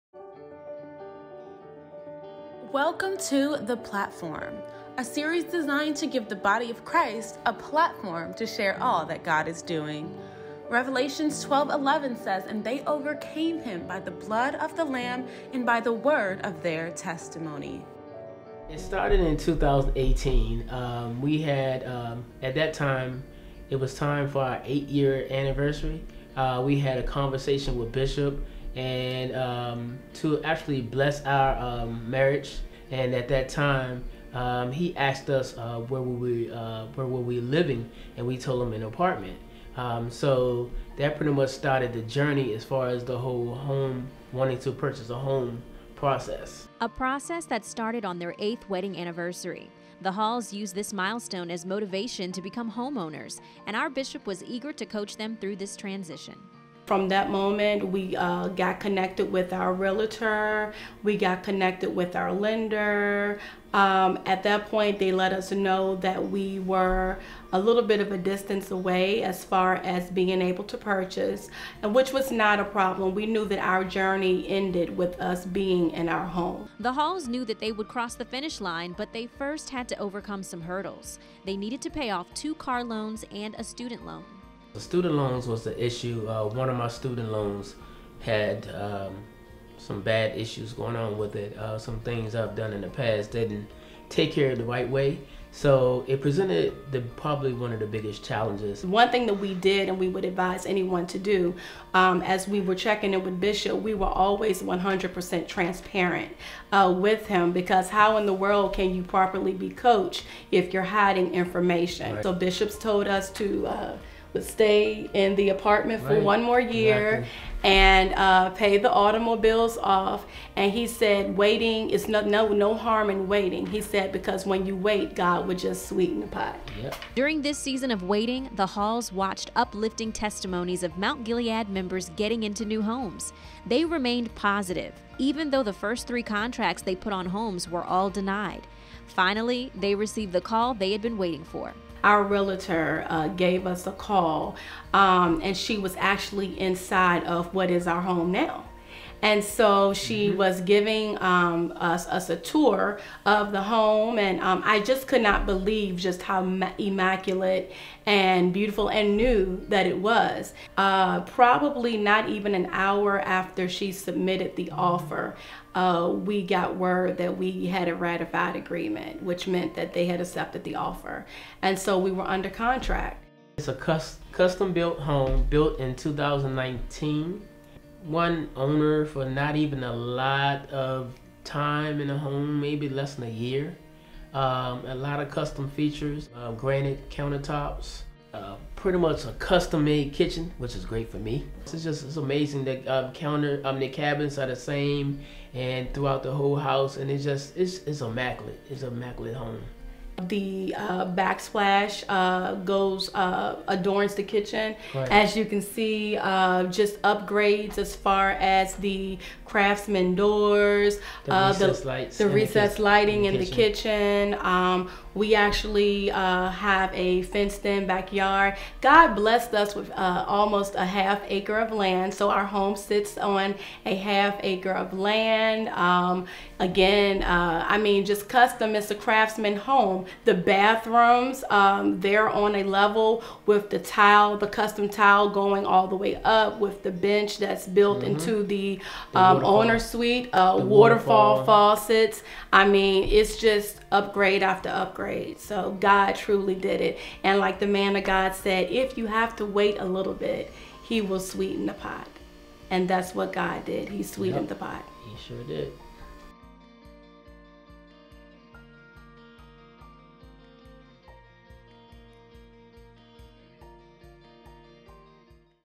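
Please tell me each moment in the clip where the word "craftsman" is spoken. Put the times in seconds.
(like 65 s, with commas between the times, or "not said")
209 s, 228 s.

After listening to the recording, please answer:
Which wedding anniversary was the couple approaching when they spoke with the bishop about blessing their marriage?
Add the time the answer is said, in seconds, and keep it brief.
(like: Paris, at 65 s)
8th, at 24 s.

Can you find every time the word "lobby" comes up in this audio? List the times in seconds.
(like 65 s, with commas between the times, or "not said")
not said.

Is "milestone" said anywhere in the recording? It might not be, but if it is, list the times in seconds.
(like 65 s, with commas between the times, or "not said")
50 s.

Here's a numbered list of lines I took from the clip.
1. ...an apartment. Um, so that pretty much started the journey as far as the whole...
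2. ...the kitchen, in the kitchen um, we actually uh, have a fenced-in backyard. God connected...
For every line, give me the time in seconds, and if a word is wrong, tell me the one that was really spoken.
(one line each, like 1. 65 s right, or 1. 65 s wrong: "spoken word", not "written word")
1. 38 s right
2. 213 s wrong: "blessed", not "connected".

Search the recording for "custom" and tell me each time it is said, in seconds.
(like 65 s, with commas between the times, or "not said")
174 s, 185 s, 189 s, 228 s, 234 s.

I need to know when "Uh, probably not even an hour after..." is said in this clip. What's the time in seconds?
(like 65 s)
160 s.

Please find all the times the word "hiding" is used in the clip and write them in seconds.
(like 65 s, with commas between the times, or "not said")
110 s.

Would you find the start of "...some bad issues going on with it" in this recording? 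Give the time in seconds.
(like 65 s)
89 s.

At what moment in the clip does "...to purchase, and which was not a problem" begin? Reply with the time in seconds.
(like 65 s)
70 s.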